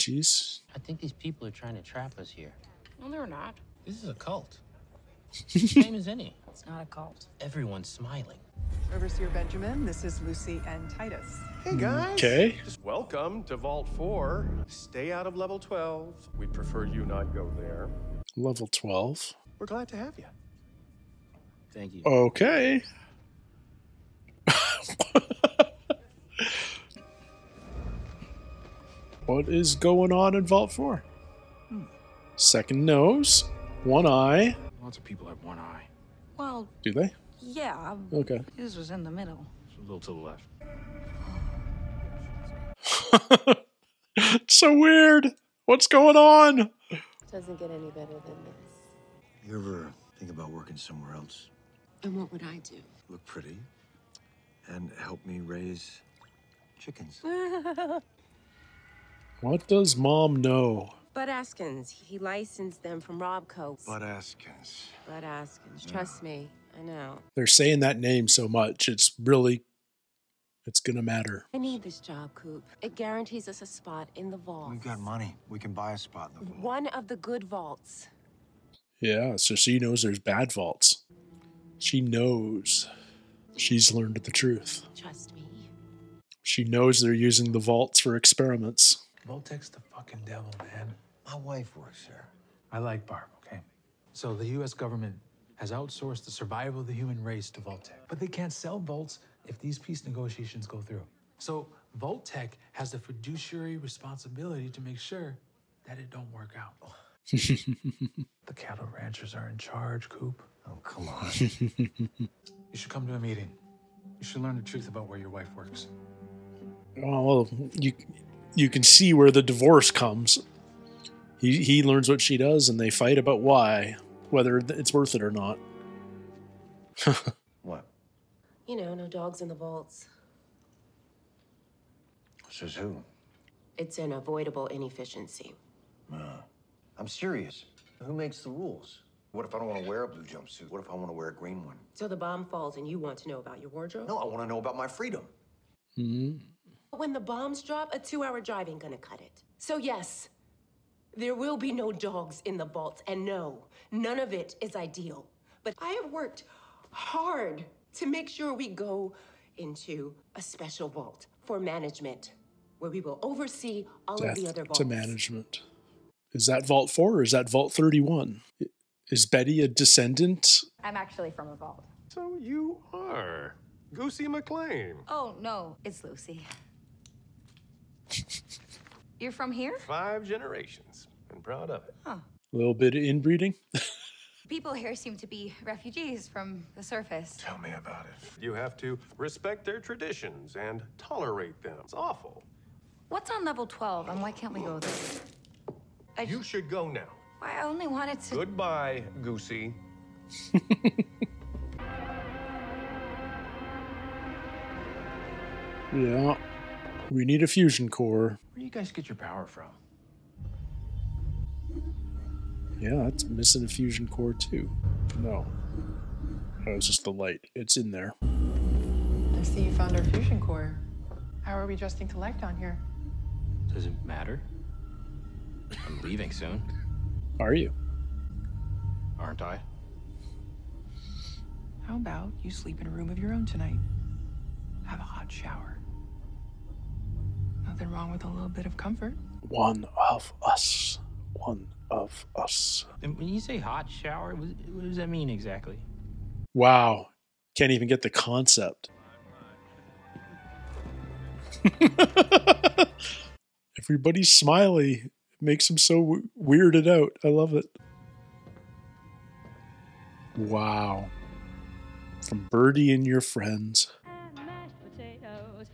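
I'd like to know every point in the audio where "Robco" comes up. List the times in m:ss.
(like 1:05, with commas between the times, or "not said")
1:03.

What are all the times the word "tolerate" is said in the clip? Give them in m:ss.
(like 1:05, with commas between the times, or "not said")
3:10.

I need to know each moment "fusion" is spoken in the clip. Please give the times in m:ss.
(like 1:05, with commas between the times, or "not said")
3:27, 3:33, 3:40.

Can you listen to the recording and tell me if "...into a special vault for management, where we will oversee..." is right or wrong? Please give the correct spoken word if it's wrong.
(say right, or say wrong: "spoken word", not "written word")
right.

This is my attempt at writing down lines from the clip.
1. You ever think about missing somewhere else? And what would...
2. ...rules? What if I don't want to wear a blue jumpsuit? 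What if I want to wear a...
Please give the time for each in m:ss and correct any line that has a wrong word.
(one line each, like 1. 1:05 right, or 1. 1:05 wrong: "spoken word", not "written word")
1. 0:49 wrong: "working", not "missing"
2. 2:18 right.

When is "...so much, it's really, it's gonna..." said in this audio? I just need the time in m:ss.
1:08.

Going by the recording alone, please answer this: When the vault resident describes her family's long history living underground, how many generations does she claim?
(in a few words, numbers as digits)
5.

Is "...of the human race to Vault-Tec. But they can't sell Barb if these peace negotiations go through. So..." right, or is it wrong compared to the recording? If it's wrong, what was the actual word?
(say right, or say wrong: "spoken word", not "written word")
wrong: "Volts", not "Barb".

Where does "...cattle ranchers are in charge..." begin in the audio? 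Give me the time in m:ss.
1:48.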